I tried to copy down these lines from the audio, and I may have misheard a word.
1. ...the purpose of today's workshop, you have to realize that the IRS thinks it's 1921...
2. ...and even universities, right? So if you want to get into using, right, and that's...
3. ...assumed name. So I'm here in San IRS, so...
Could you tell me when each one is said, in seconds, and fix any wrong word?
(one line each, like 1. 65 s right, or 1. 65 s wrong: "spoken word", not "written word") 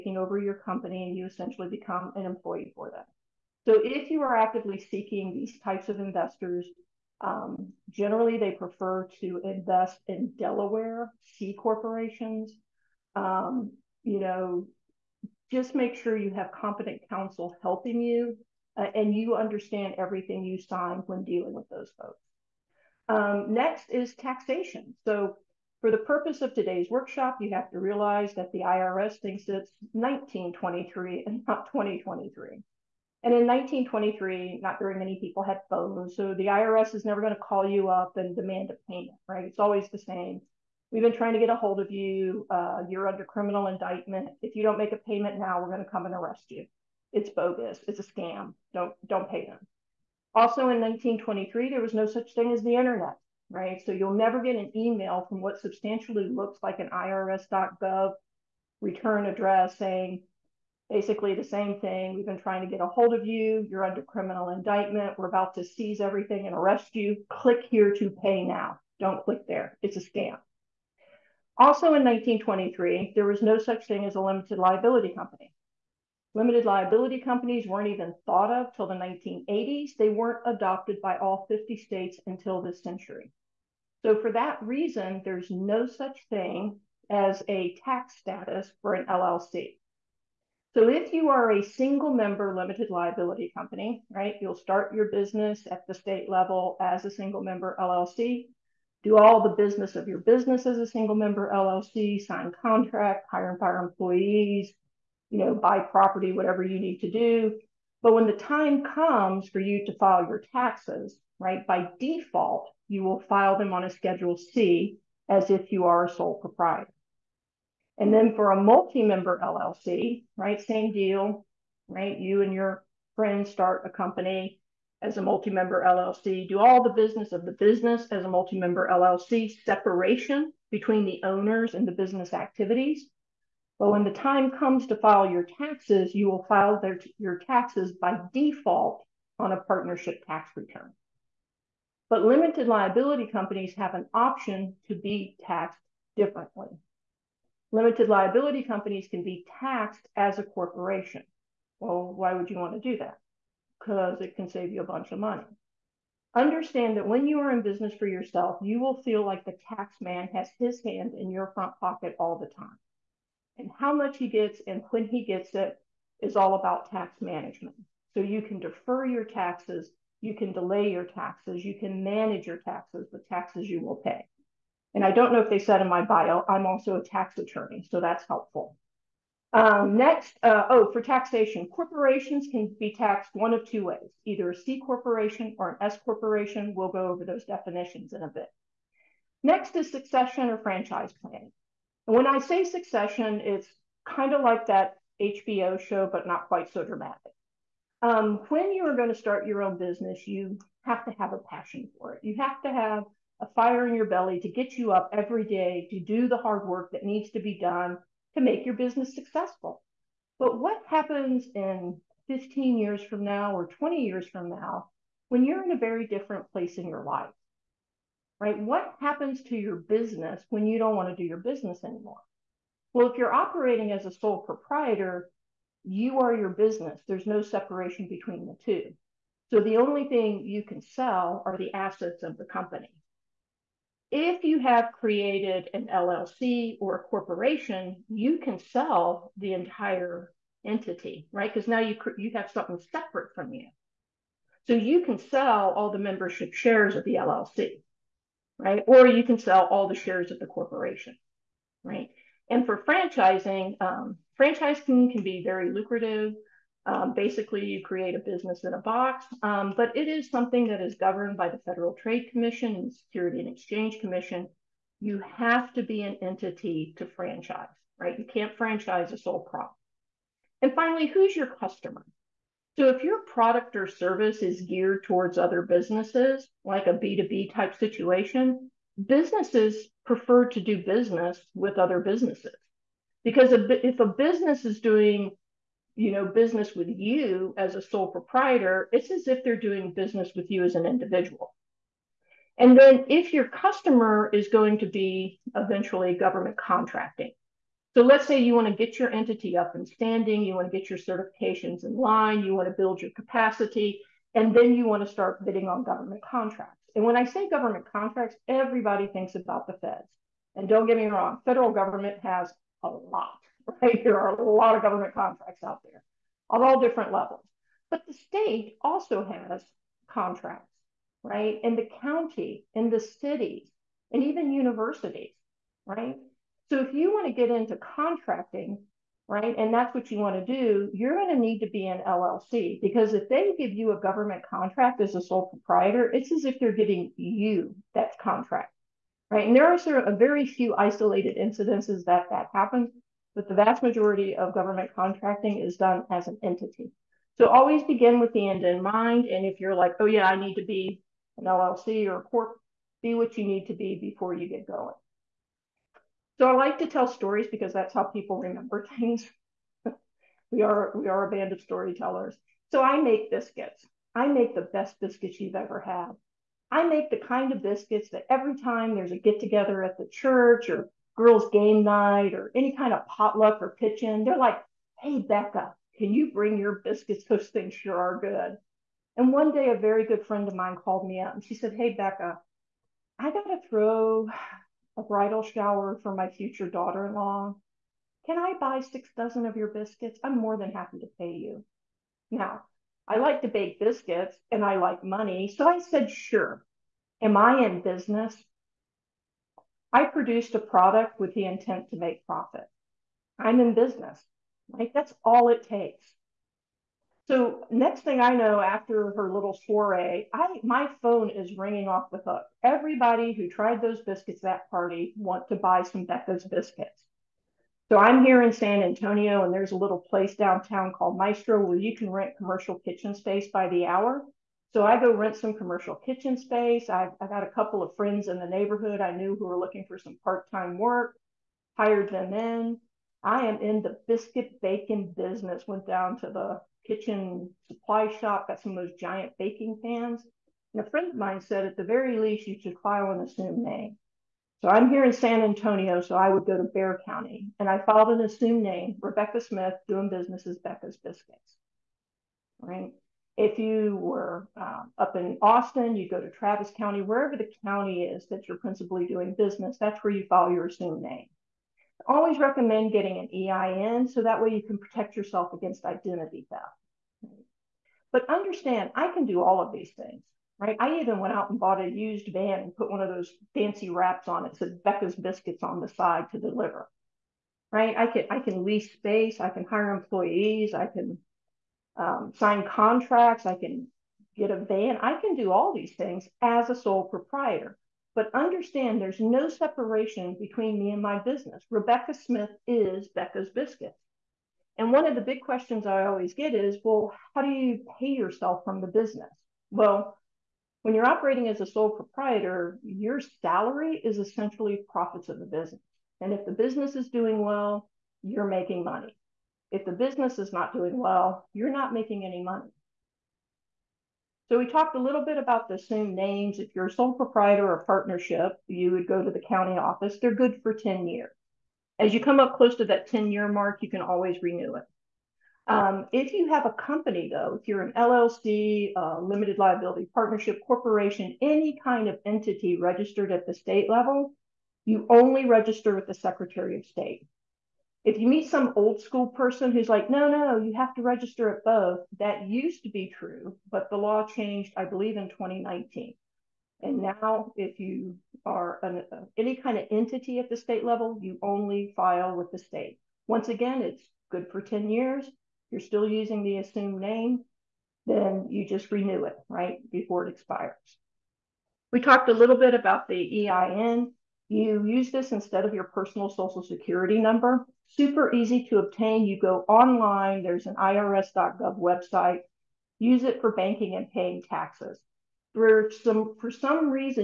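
1. 25 s wrong: "1923", not "1921"
2. 324 s wrong: "contracting", not "using"
3. 443 s wrong: "Antonio", not "IRS".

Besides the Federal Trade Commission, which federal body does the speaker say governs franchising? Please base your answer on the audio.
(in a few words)
Security and Exchange Commission.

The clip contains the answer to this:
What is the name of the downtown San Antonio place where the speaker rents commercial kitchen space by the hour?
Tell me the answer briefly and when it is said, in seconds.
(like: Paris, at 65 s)
Maestro, at 421 s.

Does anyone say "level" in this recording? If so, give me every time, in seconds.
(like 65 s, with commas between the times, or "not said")
96 s, 317 s, 533 s, 550 s.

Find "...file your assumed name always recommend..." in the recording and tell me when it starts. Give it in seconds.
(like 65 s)
460 s.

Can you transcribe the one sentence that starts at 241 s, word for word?
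Because now you you have something separate from you.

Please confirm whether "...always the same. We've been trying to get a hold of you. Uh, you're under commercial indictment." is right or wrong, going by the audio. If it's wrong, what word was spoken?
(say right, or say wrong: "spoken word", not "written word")
wrong: "criminal", not "commercial".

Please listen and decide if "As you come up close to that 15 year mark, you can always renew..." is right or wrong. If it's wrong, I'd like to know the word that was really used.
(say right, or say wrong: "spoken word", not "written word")
wrong: "10", not "15".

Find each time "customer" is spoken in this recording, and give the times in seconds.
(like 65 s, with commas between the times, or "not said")
271 s, 293 s.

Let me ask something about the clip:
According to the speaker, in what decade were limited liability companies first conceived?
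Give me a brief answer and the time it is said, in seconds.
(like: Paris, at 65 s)
1980s, at 78 s.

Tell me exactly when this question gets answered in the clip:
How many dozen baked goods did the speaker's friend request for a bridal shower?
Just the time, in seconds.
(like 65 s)
388 s.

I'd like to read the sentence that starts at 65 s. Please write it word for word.
We're about to seize everything and arrest you.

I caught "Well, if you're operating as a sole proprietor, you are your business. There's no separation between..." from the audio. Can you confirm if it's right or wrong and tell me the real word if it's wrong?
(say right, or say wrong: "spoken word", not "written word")
right.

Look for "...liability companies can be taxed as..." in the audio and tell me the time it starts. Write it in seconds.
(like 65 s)
148 s.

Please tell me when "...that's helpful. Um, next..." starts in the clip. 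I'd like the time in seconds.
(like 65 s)
178 s.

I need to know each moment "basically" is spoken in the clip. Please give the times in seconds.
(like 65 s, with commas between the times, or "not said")
60 s, 257 s.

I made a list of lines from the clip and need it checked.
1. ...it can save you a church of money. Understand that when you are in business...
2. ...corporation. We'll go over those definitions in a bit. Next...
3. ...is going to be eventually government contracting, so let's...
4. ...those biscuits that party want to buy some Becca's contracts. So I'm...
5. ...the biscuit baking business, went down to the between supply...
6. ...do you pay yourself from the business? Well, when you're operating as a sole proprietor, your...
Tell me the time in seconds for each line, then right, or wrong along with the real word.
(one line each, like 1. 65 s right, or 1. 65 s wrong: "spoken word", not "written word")
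1. 154 s wrong: "bunch", not "church"
2. 186 s right
3. 294 s right
4. 413 s wrong: "biscuits", not "contracts"
5. 433 s wrong: "kitchen", not "between"
6. 497 s right.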